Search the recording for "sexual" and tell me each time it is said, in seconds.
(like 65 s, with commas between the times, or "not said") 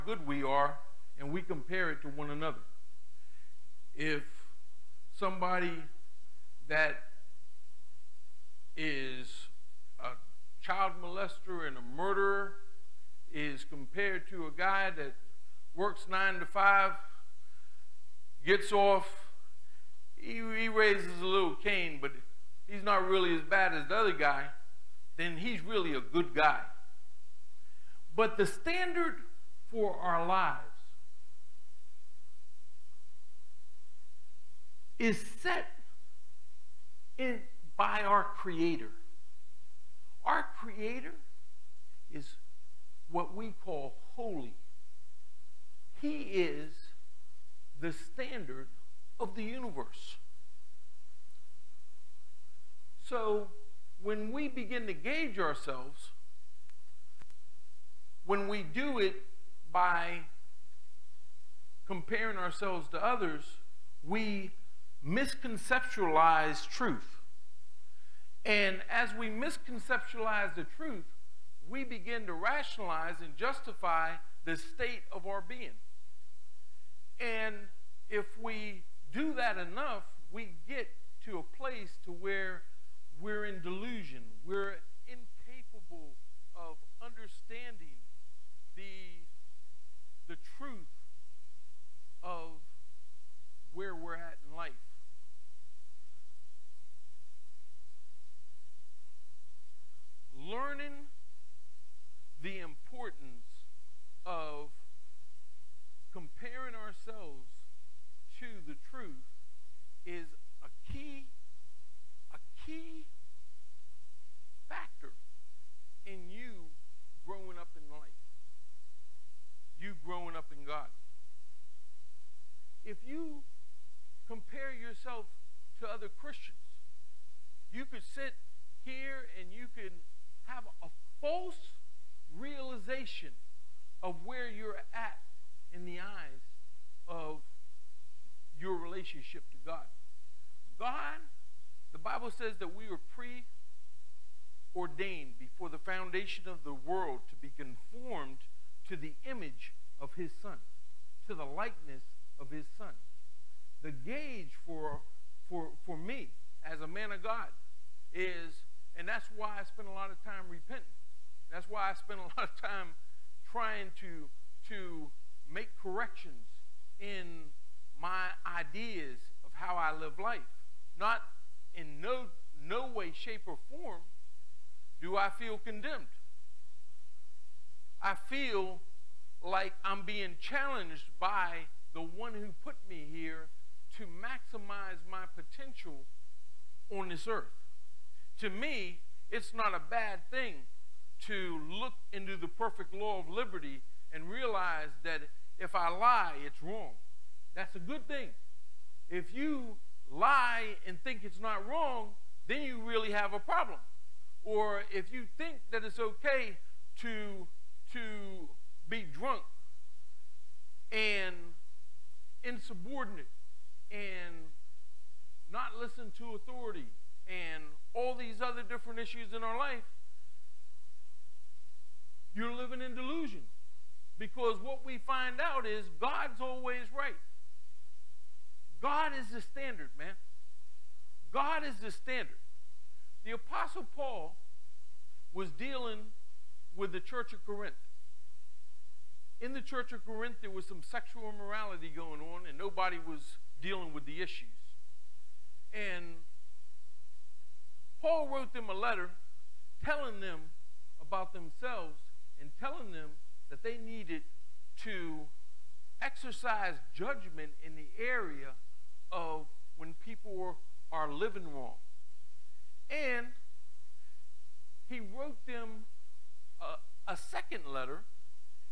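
240 s.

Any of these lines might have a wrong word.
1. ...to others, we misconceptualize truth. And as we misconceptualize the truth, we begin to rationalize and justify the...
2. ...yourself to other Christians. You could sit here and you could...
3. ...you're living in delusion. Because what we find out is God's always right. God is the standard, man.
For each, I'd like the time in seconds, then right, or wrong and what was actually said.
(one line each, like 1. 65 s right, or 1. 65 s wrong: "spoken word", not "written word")
1. 62 s right
2. 124 s right
3. 222 s right.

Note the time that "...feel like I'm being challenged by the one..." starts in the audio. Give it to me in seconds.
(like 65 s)
178 s.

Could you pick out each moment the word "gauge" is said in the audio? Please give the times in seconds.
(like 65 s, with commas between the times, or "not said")
54 s, 153 s.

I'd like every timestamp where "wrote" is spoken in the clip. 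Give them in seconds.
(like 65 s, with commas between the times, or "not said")
248 s, 264 s.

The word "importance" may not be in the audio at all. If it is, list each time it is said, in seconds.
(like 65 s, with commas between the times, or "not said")
102 s.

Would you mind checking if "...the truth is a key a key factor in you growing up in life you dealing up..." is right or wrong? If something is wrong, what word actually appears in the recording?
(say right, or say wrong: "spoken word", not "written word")
wrong: "growing", not "dealing".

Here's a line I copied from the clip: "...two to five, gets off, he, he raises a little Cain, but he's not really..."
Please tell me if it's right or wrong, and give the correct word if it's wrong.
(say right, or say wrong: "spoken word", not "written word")
wrong: "nine", not "two".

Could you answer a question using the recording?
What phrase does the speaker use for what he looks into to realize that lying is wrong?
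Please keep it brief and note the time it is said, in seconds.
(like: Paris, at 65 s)
the perfect law of liberty, at 192 s.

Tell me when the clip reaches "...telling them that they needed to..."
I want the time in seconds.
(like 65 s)
252 s.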